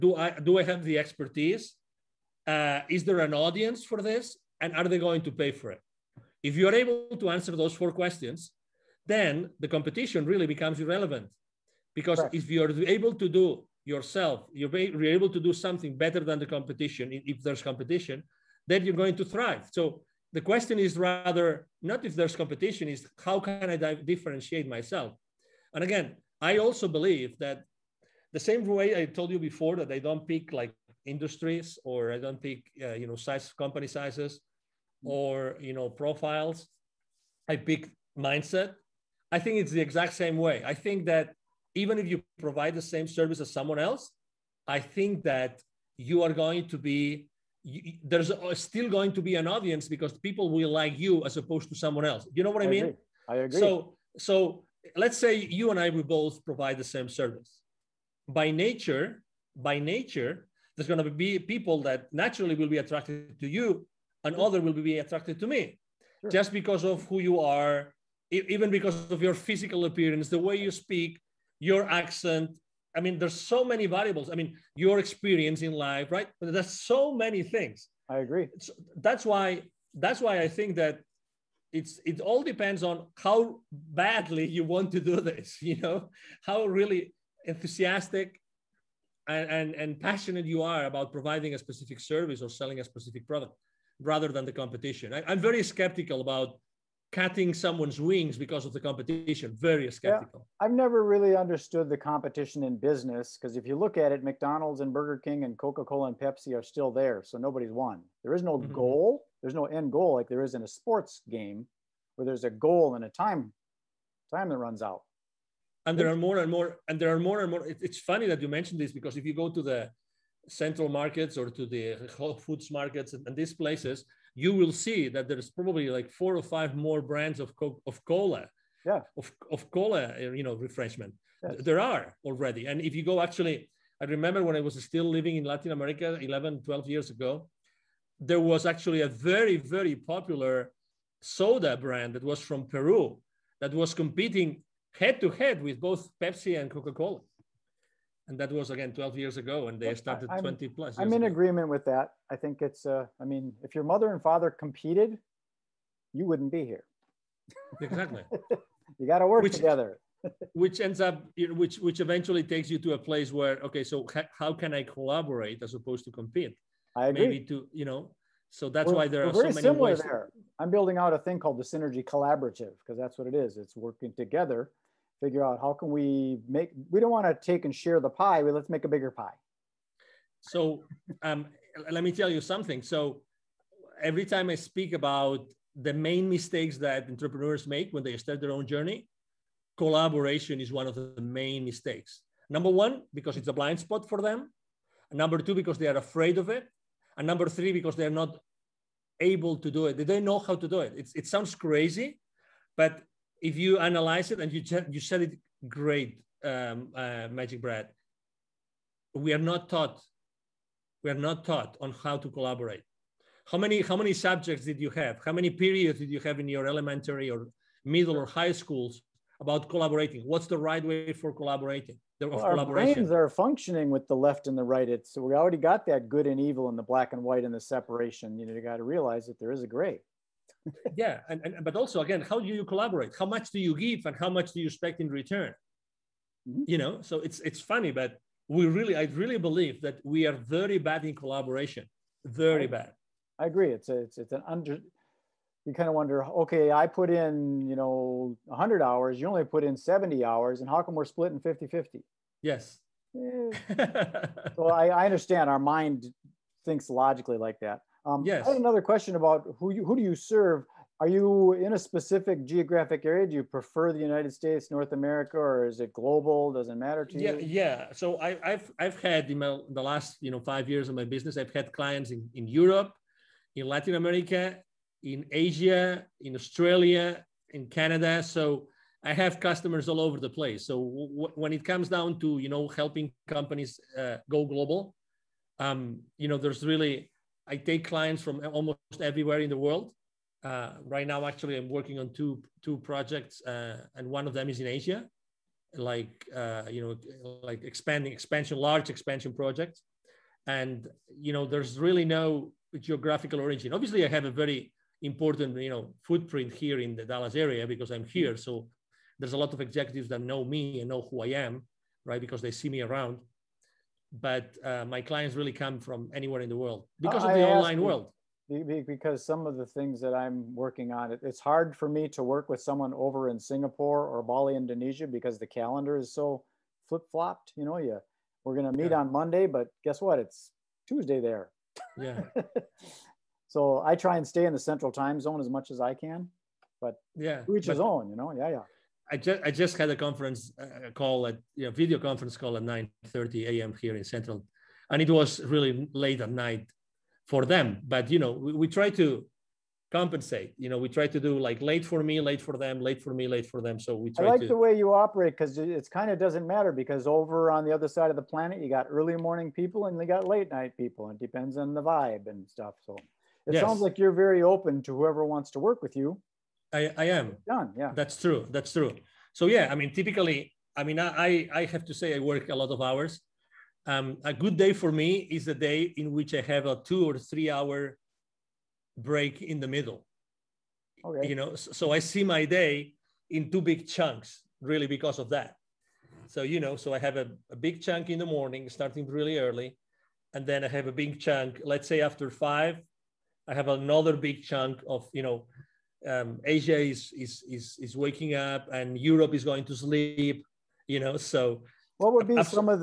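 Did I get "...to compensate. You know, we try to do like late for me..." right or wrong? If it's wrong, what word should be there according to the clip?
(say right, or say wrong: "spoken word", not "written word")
right.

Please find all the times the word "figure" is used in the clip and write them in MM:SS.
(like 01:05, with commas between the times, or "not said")
02:55.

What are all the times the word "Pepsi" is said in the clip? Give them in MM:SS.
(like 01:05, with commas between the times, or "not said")
01:46, 02:26.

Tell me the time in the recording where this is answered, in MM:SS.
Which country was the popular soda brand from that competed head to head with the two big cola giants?
02:22.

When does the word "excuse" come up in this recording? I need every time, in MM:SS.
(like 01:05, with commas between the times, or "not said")
not said.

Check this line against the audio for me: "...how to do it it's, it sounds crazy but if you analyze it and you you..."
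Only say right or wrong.
right.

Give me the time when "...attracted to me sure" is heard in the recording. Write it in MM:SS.
01:04.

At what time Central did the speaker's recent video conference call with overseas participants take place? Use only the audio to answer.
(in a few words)
9:30 a.m.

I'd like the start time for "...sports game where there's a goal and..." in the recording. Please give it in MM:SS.
01:50.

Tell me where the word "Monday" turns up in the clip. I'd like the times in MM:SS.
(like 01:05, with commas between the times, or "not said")
05:29.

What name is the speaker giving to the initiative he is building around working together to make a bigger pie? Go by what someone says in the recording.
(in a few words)
the synergy collaborative.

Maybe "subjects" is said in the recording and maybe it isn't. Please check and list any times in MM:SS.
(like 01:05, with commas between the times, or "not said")
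03:34.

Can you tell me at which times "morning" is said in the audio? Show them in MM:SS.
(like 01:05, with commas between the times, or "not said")
05:59, 06:28.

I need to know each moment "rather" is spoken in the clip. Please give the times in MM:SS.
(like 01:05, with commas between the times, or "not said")
00:20, 01:34.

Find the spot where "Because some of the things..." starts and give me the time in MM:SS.
05:18.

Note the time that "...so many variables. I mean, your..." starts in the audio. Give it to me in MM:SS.
01:13.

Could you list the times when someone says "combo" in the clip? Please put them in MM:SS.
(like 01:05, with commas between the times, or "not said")
not said.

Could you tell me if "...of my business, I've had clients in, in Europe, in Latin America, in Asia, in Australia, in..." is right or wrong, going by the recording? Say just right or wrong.
right.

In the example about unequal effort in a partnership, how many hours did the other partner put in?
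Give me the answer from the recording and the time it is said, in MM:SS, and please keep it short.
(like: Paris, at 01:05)
70, at 04:09.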